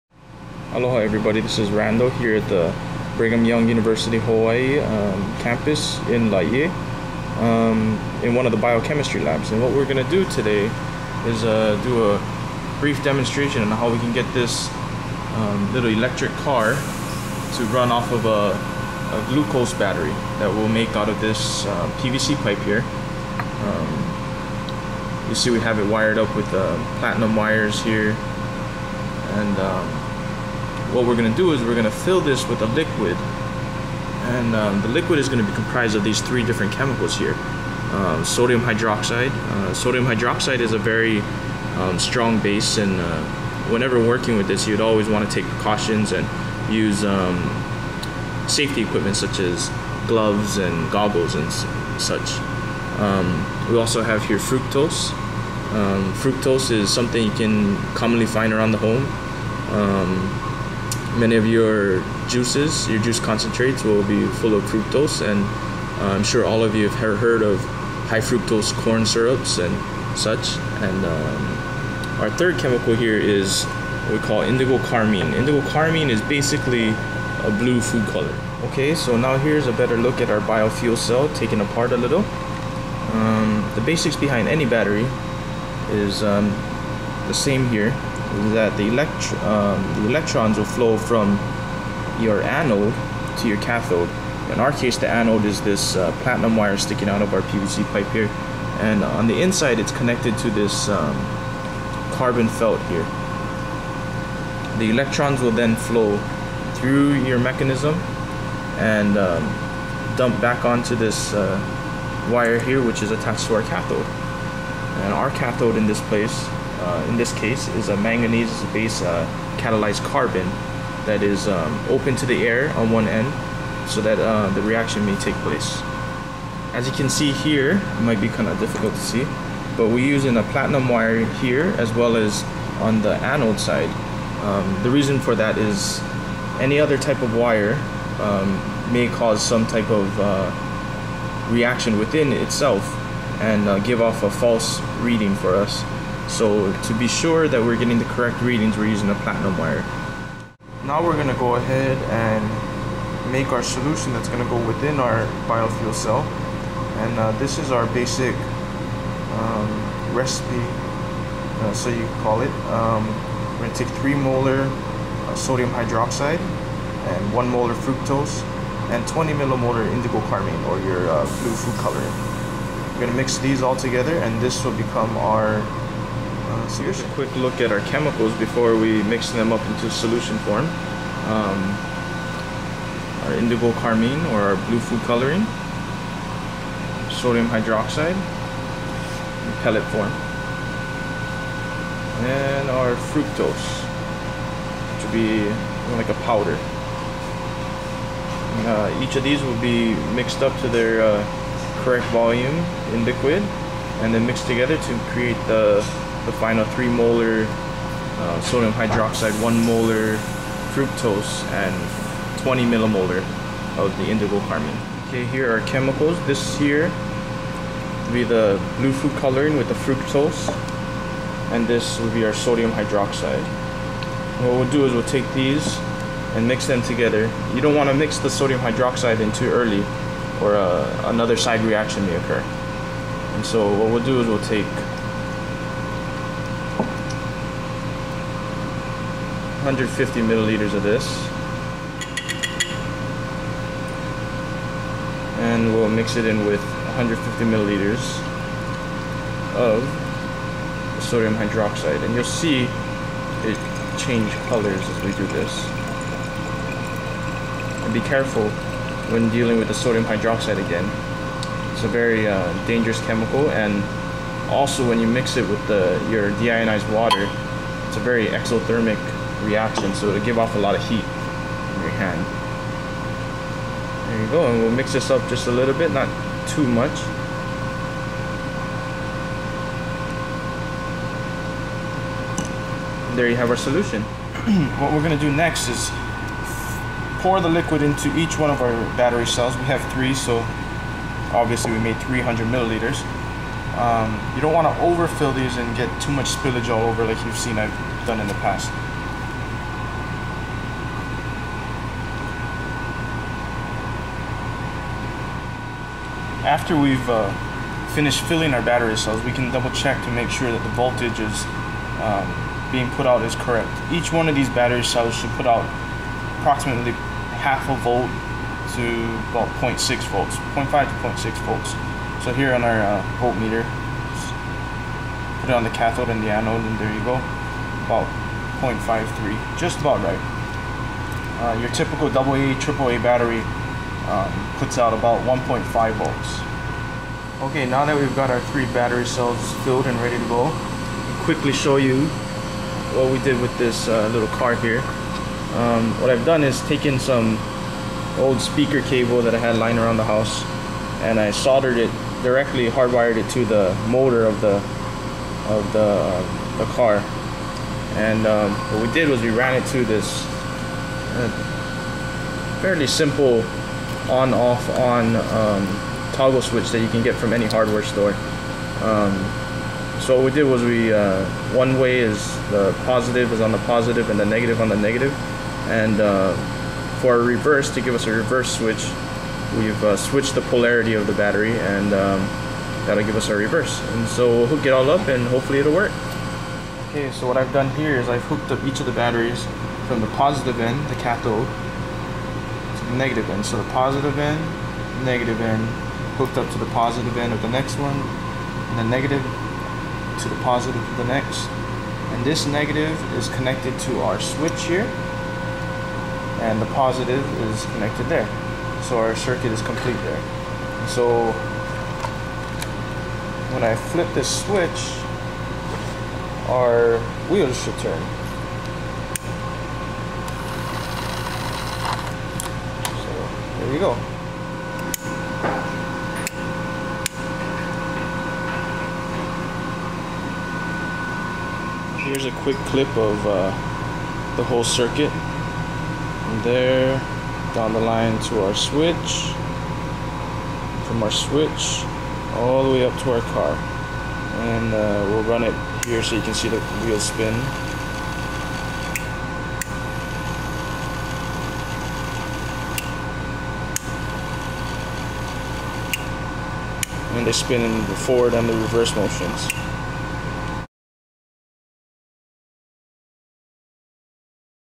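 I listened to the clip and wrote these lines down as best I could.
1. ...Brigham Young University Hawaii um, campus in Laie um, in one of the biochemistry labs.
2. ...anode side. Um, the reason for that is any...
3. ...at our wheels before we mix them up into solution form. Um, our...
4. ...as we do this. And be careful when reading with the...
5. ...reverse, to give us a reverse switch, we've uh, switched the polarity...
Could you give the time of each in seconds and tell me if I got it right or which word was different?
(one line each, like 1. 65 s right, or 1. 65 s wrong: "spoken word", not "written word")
1. 3 s right
2. 133 s right
3. 177 s wrong: "chemicals", not "wheels"
4. 254 s wrong: "dealing", not "reading"
5. 377 s right.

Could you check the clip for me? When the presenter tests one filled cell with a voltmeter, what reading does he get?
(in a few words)
0.53 volts.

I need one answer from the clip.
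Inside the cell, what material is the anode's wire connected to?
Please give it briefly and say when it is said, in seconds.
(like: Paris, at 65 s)
Carbon felt, at 102 s.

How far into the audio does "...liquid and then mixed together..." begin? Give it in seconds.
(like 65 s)
203 s.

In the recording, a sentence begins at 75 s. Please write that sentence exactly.
Indigo carmine is basically a blue food color.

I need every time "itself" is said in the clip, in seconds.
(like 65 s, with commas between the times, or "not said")
142 s.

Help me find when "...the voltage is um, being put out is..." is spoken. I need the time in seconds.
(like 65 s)
310 s.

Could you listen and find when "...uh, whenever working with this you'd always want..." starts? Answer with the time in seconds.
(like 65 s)
42 s.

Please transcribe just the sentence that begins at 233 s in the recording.
And so what we'll do is we'll take 150 milliliters of this.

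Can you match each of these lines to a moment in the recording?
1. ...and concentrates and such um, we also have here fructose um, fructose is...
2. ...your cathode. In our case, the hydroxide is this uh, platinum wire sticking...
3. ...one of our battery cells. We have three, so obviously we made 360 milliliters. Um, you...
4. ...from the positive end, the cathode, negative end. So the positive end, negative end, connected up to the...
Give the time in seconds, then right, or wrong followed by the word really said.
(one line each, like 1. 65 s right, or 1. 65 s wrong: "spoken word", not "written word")
1. 50 s wrong: "goggles", not "concentrates"
2. 93 s wrong: "anode", not "hydroxide"
3. 288 s wrong: "300", not "360"
4. 389 s wrong: "hooked", not "connected".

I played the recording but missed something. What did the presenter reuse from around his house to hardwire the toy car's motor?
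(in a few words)
Old speaker cable.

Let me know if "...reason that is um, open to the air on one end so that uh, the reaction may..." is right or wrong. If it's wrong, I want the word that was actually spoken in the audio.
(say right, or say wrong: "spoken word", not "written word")
wrong: "carbon", not "reason".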